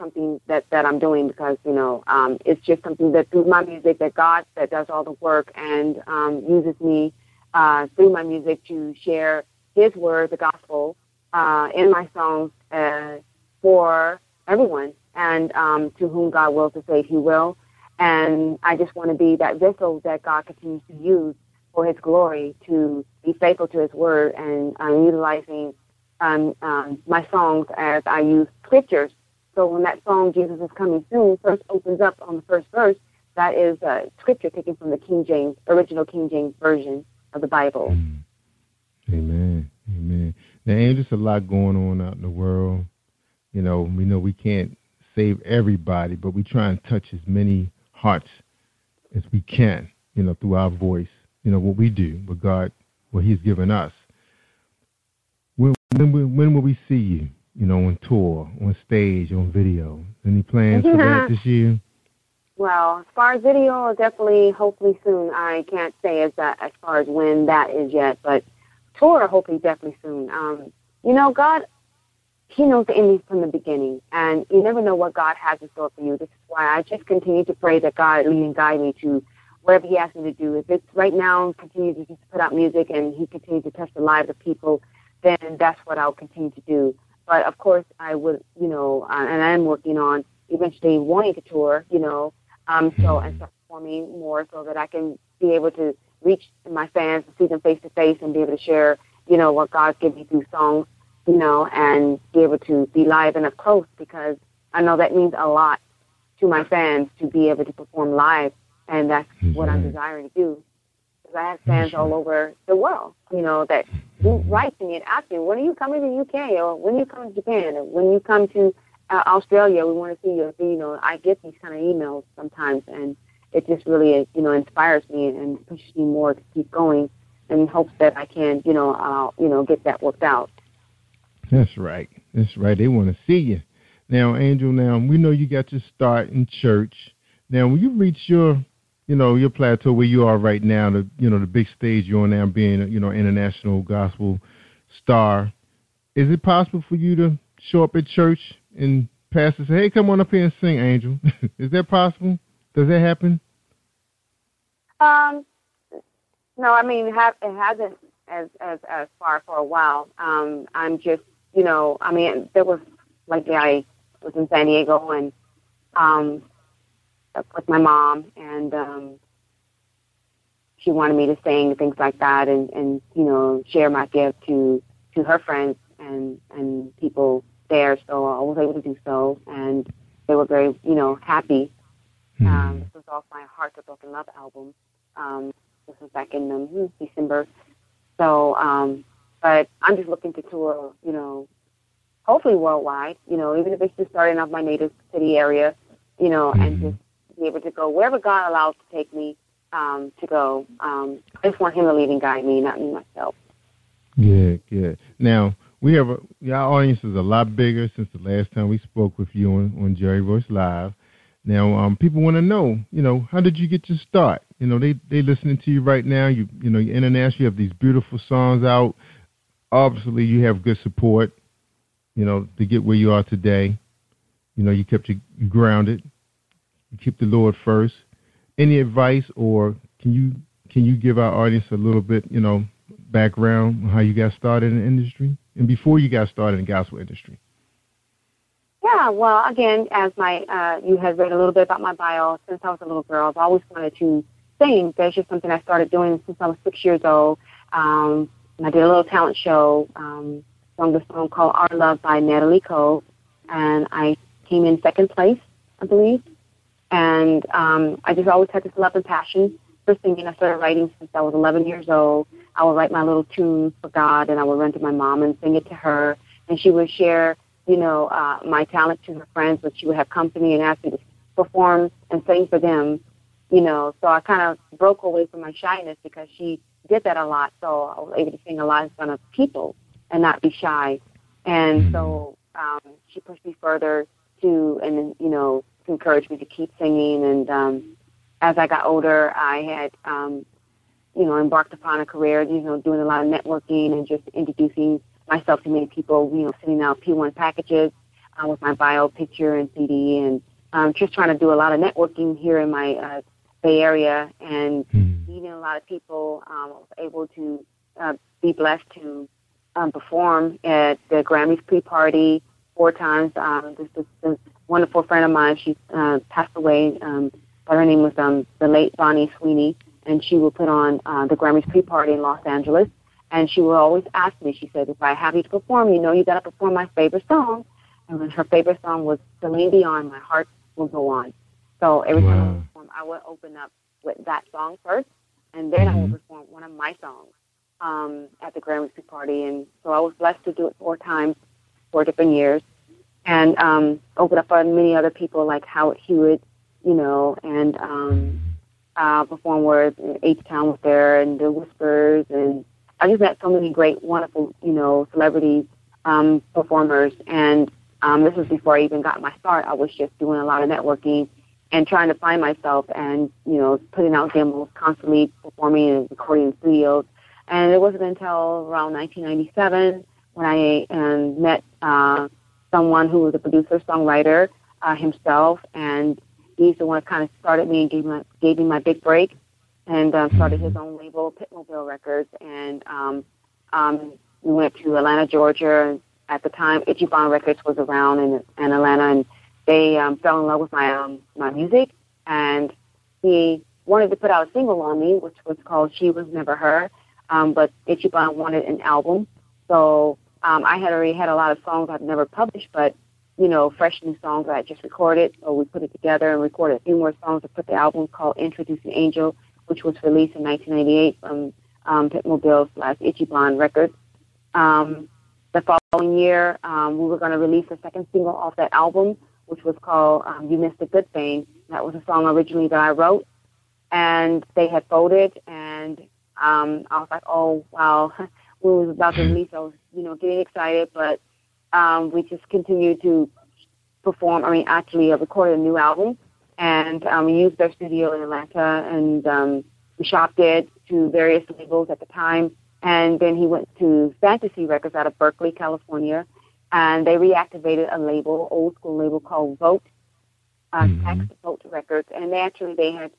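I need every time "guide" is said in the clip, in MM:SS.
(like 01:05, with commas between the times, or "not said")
01:18, 03:22.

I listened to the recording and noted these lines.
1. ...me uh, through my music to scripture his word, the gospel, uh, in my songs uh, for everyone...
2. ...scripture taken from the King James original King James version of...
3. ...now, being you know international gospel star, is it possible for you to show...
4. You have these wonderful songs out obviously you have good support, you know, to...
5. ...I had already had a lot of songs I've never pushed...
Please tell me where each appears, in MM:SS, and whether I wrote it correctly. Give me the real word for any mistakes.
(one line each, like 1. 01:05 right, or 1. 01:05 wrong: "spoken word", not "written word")
1. 00:06 wrong: "share", not "scripture"
2. 00:34 right
3. 02:22 right
4. 03:37 wrong: "beautiful", not "wonderful"
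5. 06:40 wrong: "published", not "pushed".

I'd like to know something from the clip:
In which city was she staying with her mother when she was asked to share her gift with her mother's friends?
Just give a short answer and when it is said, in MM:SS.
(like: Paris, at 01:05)
San Diego, at 02:44.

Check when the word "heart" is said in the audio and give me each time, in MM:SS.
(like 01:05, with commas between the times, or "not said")
00:47, 03:03, 05:30.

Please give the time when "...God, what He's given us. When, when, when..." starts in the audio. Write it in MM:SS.
00:52.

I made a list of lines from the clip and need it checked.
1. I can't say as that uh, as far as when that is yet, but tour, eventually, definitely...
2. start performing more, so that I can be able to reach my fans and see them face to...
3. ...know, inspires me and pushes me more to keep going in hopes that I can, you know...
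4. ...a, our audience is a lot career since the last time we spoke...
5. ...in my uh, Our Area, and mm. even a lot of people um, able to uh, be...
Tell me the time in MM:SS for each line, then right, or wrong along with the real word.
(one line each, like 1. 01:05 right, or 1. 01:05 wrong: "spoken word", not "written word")
1. 01:05 wrong: "hopefully", not "eventually"
2. 01:33 right
3. 02:04 right
4. 03:26 wrong: "bigger", not "career"
5. 05:02 wrong: "Bay", not "Our".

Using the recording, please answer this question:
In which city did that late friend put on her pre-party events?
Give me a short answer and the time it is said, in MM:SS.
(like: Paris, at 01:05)
Los Angeles, at 05:22.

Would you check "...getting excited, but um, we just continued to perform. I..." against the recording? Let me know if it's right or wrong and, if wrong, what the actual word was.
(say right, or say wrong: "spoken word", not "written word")
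right.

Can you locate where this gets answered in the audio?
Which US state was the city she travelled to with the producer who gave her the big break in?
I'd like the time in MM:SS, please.
06:25.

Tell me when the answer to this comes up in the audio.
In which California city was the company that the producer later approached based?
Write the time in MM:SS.
07:25.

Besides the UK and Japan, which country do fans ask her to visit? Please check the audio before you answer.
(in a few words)
Australia.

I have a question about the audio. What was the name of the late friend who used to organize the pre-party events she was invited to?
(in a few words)
Bonnie Sweeney.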